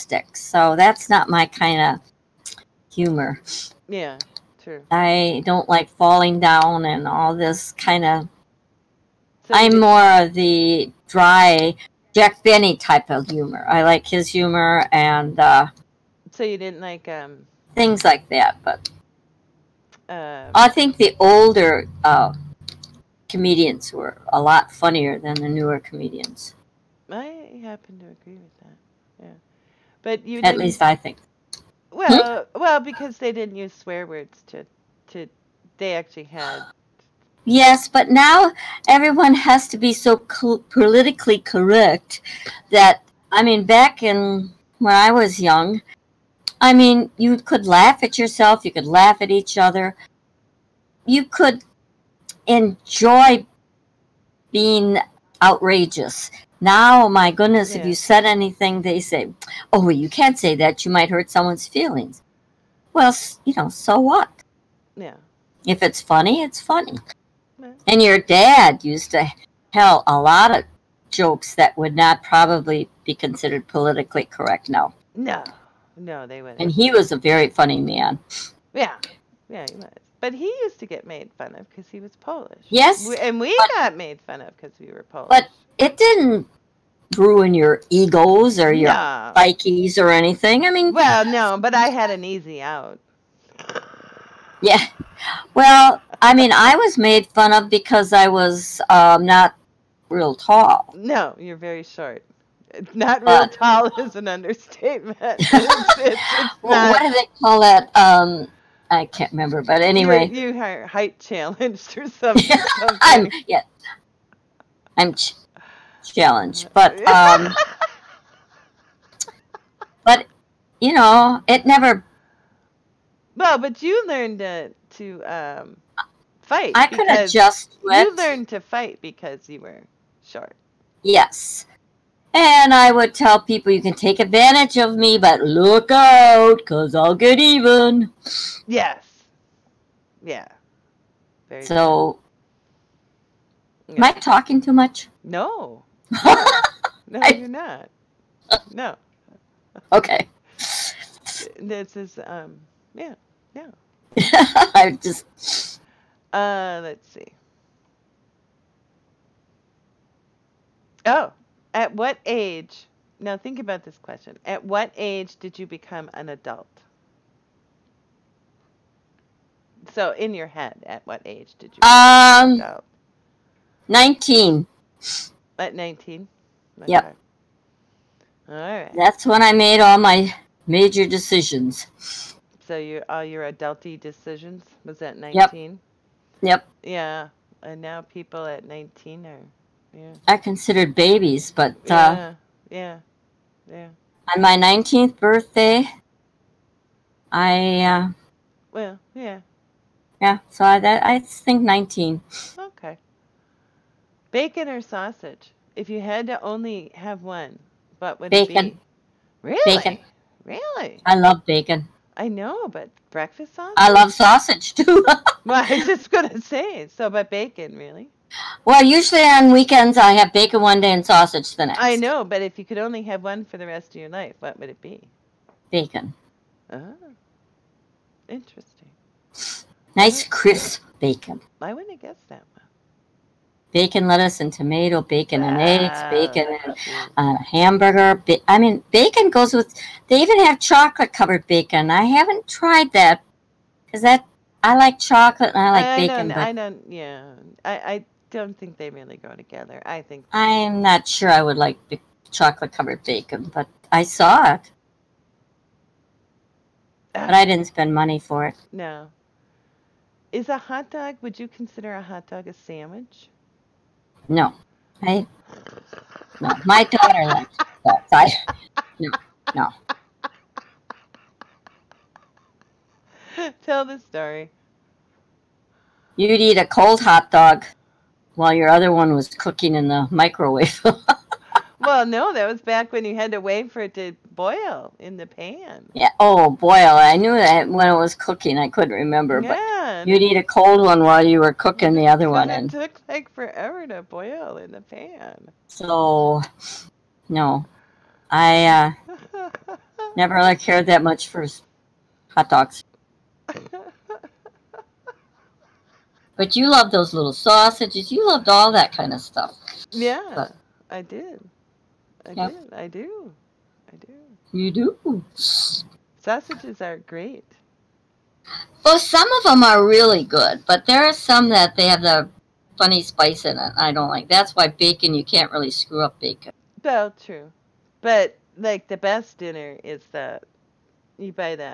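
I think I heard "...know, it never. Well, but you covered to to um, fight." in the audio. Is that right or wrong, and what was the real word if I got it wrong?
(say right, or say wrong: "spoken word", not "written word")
wrong: "learned", not "covered".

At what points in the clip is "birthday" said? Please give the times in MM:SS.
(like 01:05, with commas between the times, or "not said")
03:15.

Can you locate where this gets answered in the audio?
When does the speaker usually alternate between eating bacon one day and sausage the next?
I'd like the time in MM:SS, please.
03:39.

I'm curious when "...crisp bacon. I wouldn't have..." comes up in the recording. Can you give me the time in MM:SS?
03:50.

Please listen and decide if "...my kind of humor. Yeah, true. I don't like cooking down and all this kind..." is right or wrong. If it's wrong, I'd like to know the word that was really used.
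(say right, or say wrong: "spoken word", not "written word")
wrong: "falling", not "cooking".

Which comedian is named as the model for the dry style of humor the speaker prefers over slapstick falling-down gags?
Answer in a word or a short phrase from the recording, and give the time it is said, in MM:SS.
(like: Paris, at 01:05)
Jack Benny, at 00:12.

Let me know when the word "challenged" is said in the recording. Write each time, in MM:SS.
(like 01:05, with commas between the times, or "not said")
01:51, 01:56.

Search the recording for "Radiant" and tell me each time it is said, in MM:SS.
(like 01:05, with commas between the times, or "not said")
not said.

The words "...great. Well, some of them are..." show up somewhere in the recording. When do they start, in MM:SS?
05:16.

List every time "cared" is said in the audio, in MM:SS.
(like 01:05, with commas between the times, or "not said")
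05:00.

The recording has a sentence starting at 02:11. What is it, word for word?
Yes, and I would tell people, you can take advantage of me, but look out, because I'll get even.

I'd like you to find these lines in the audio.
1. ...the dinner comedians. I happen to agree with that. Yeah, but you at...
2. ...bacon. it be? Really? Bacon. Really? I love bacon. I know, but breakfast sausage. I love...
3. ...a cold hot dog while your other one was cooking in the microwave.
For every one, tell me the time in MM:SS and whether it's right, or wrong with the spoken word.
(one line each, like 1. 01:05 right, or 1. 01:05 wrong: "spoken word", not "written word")
1. 00:25 wrong: "newer", not "dinner"
2. 03:28 right
3. 04:36 right.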